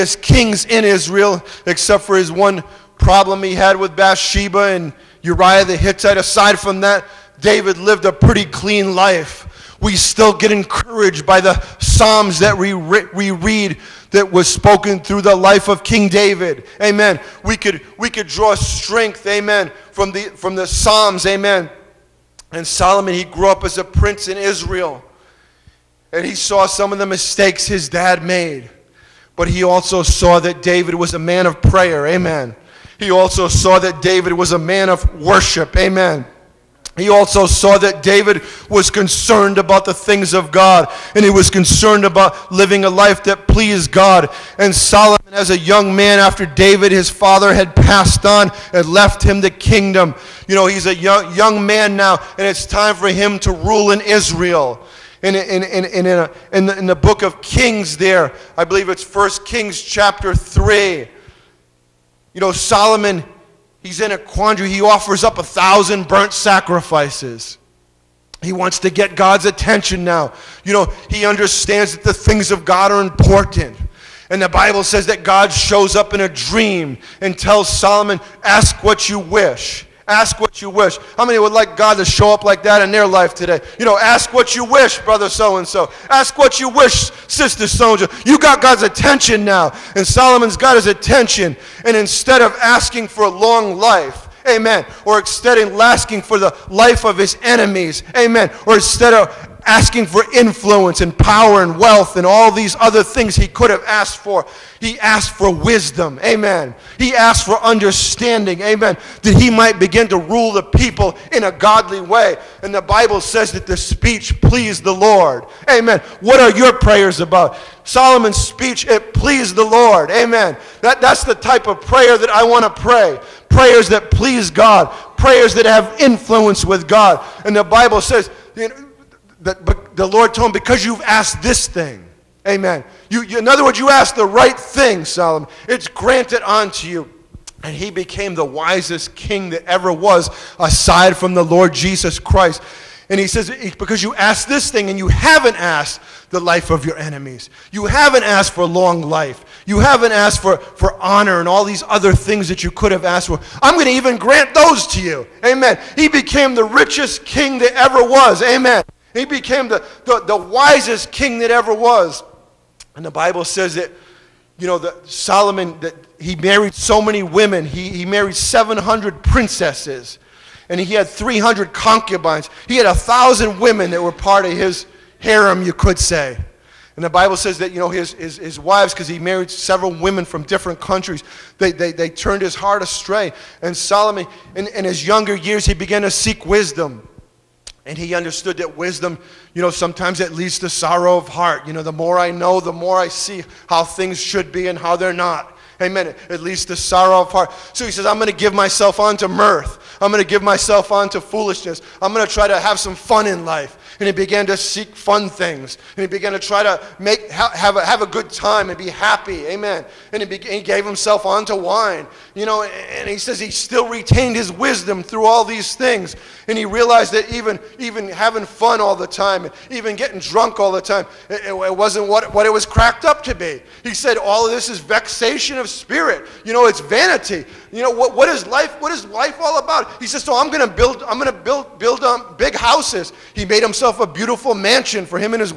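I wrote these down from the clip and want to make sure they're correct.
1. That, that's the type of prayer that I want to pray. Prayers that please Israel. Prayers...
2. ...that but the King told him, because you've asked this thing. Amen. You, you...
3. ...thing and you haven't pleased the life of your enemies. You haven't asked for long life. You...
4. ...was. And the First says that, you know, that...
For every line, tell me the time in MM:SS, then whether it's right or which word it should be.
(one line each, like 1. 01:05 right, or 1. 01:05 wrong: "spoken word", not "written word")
1. 02:00 wrong: "God", not "Israel"
2. 02:09 wrong: "Lord", not "King"
3. 02:24 wrong: "asked", not "pleased"
4. 02:41 wrong: "Bible", not "First".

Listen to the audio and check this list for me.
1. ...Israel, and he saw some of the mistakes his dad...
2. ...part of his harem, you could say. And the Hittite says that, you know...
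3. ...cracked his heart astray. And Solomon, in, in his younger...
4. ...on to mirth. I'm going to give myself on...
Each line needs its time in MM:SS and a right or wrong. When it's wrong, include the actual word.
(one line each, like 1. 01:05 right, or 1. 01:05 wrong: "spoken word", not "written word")
1. 00:24 right
2. 02:54 wrong: "Bible", not "Hittite"
3. 03:02 wrong: "turned", not "cracked"
4. 03:18 right.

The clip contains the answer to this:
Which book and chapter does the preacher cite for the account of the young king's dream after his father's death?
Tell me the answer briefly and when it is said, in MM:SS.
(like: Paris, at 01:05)
First Kings chapter 3, at 00:59.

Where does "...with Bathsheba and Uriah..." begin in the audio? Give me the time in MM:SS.
00:03.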